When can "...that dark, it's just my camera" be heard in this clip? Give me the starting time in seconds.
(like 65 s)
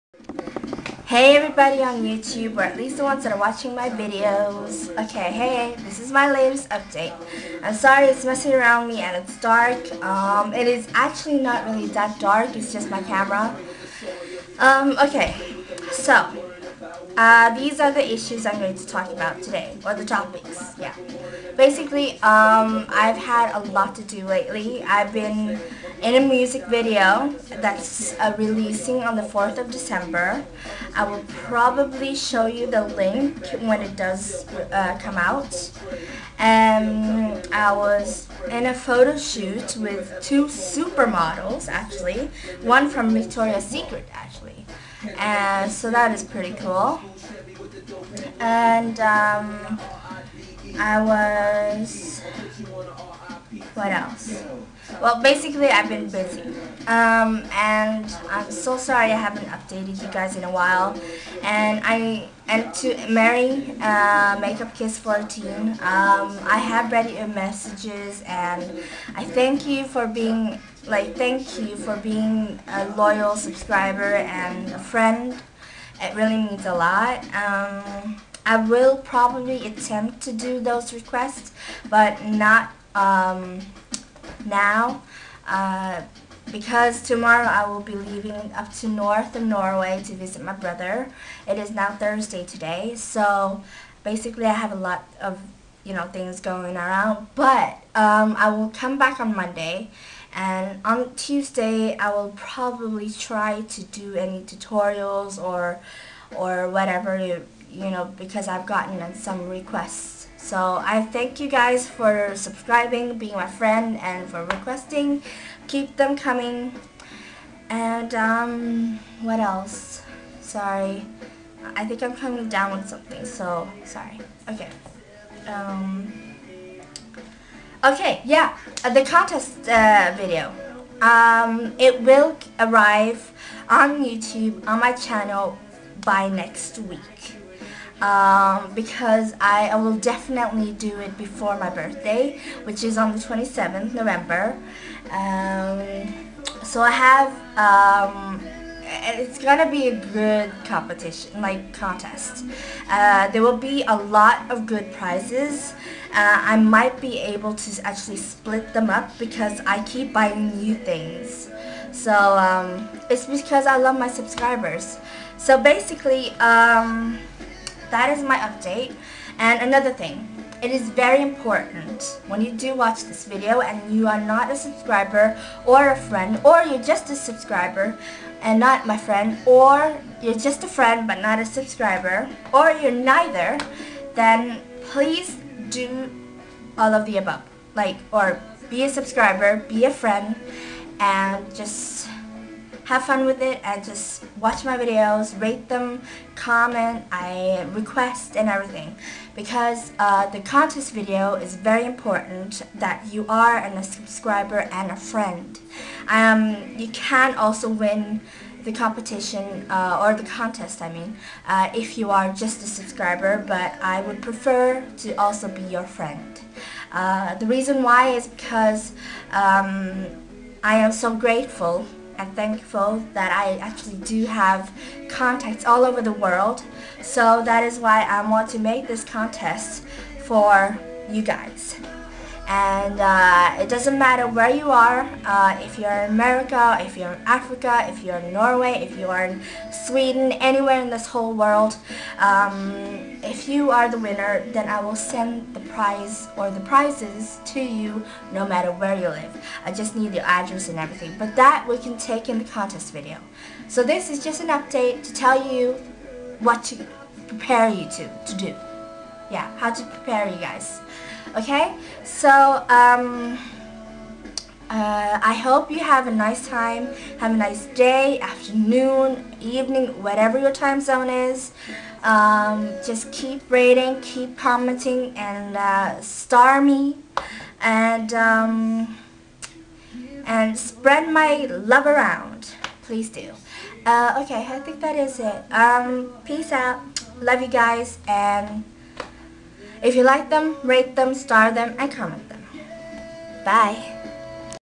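11 s.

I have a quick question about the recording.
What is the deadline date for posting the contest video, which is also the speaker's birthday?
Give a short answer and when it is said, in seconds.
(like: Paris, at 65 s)
27th November, at 143 s.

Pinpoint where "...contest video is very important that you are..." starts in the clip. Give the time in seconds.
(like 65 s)
200 s.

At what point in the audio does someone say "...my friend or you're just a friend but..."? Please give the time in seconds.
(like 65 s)
178 s.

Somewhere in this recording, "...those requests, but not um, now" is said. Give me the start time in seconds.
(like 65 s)
80 s.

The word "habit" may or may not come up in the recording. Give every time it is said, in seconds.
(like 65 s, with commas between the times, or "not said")
not said.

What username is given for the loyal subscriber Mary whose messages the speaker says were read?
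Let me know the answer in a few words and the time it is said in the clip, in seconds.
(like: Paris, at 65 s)
Makeup Kiss 14, at 64 s.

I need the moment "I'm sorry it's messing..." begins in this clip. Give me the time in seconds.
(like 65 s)
7 s.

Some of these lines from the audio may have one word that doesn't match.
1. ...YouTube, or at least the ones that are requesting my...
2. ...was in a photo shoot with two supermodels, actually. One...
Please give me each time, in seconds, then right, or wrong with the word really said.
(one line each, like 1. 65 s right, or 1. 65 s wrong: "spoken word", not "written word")
1. 2 s wrong: "watching", not "requesting"
2. 37 s right.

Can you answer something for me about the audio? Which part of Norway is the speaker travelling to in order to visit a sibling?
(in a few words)
north of Norway.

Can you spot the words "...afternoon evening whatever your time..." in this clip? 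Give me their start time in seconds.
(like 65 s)
268 s.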